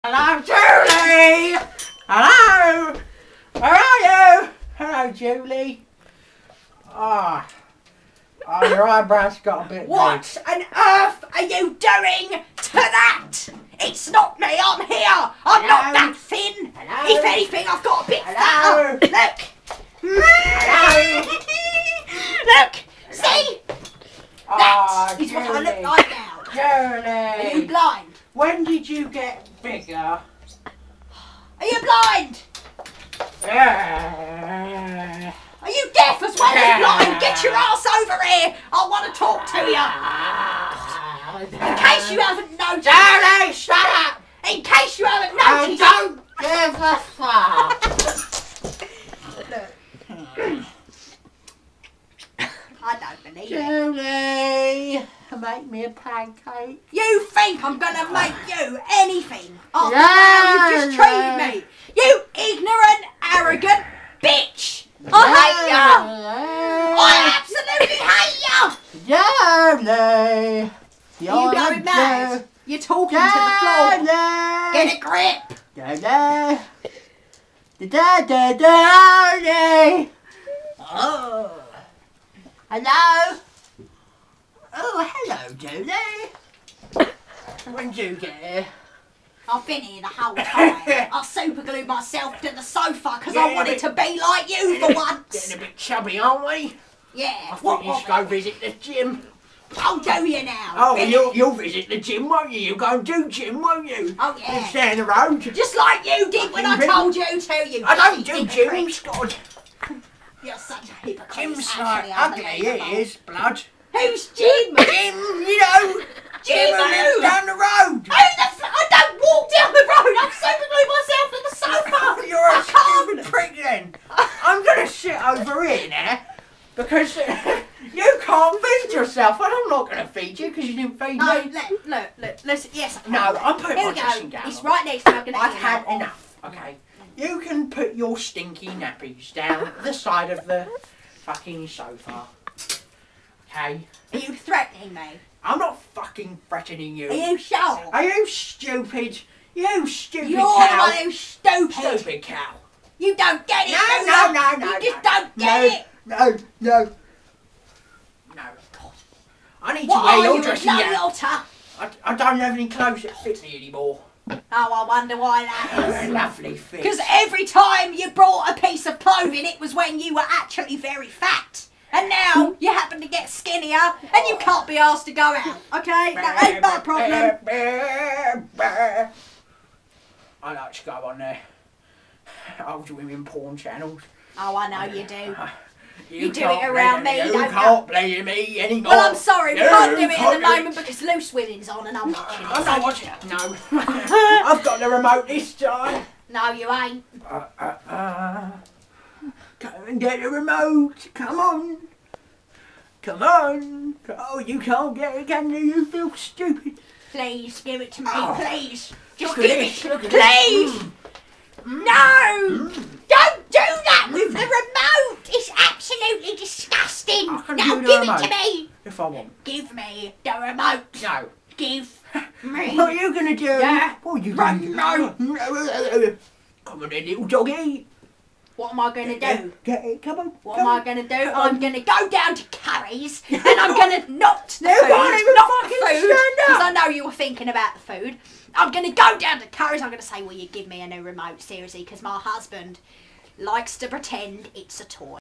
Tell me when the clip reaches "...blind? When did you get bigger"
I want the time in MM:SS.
00:27.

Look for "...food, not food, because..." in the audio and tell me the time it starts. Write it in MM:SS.
03:54.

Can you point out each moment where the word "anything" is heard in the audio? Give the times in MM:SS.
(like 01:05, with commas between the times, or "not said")
00:17, 00:58.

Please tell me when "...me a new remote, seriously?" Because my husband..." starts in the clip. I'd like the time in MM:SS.
04:00.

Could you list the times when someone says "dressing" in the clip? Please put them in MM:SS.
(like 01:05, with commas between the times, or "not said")
02:13, 02:40.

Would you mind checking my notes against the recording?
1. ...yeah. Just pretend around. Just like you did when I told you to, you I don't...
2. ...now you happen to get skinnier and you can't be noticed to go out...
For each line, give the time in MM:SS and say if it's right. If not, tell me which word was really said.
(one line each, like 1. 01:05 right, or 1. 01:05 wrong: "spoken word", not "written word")
1. 01:44 wrong: "stand", not "pretend"
2. 02:52 wrong: "asked", not "noticed".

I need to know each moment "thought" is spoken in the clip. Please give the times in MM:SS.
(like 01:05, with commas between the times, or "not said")
01:37.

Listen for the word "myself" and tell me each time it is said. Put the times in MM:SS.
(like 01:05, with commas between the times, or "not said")
01:31, 02:01.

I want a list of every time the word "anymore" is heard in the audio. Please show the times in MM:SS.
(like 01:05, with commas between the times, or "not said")
02:43, 03:08.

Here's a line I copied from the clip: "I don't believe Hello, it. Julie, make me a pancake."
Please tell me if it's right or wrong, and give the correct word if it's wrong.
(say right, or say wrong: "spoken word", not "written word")
wrong: "Julie", not "Hello".